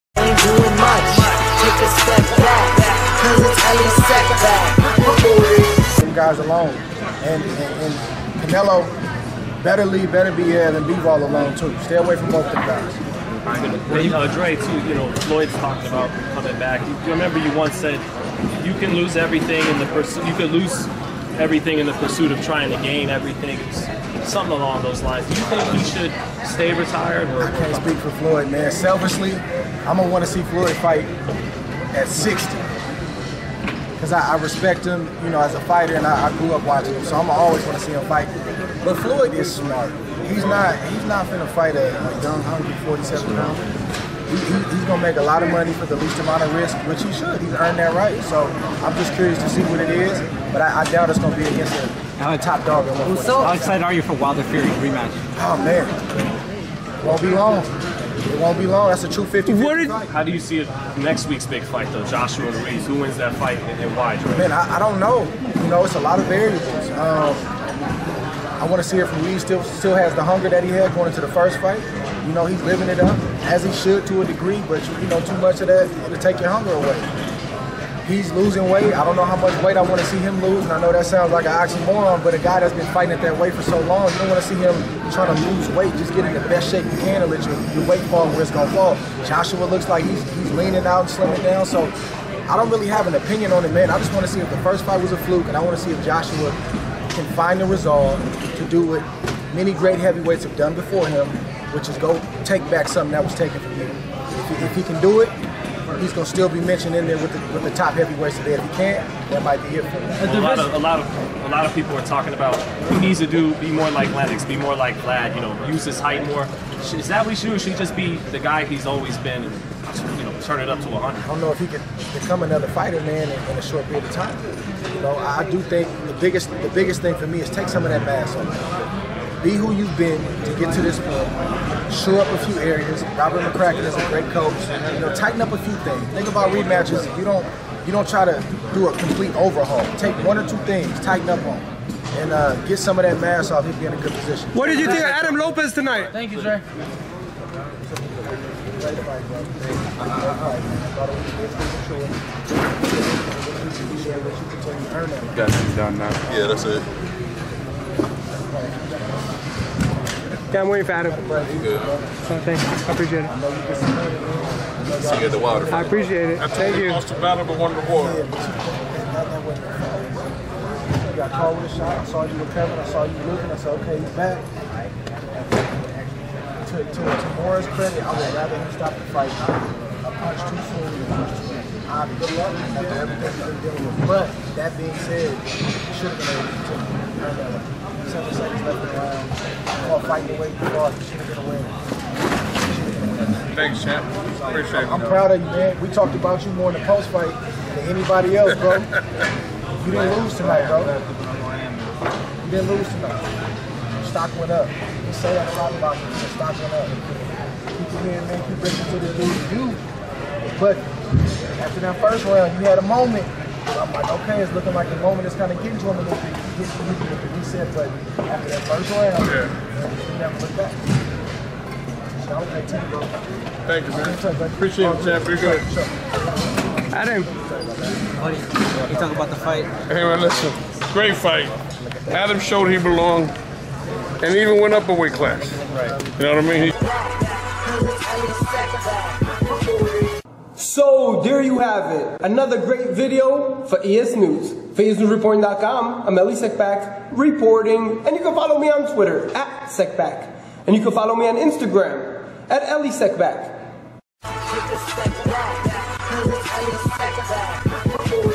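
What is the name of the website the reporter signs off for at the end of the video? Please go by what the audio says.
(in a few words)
ESNewsReporting.com.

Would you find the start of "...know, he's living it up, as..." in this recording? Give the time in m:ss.
1:12.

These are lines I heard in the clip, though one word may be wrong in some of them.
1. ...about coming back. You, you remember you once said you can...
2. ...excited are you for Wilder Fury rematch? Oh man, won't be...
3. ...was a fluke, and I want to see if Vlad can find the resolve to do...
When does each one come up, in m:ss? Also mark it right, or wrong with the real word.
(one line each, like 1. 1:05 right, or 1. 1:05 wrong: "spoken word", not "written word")
1. 0:15 right
2. 0:53 right
3. 1:35 wrong: "Joshua", not "Vlad".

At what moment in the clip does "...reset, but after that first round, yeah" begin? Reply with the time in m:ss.
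3:37.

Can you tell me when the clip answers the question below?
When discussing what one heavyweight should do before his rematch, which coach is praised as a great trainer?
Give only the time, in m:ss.
2:13.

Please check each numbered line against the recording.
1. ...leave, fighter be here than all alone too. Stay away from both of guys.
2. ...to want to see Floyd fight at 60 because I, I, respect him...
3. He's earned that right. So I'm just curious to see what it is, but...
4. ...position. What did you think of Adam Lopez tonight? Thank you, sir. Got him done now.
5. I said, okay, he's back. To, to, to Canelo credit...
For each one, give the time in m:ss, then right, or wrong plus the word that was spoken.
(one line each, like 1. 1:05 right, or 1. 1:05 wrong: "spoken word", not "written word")
1. 0:09 wrong: "better", not "fighter"
2. 0:30 right
3. 0:47 right
4. 2:24 right
5. 2:53 wrong: "Morris", not "Canelo".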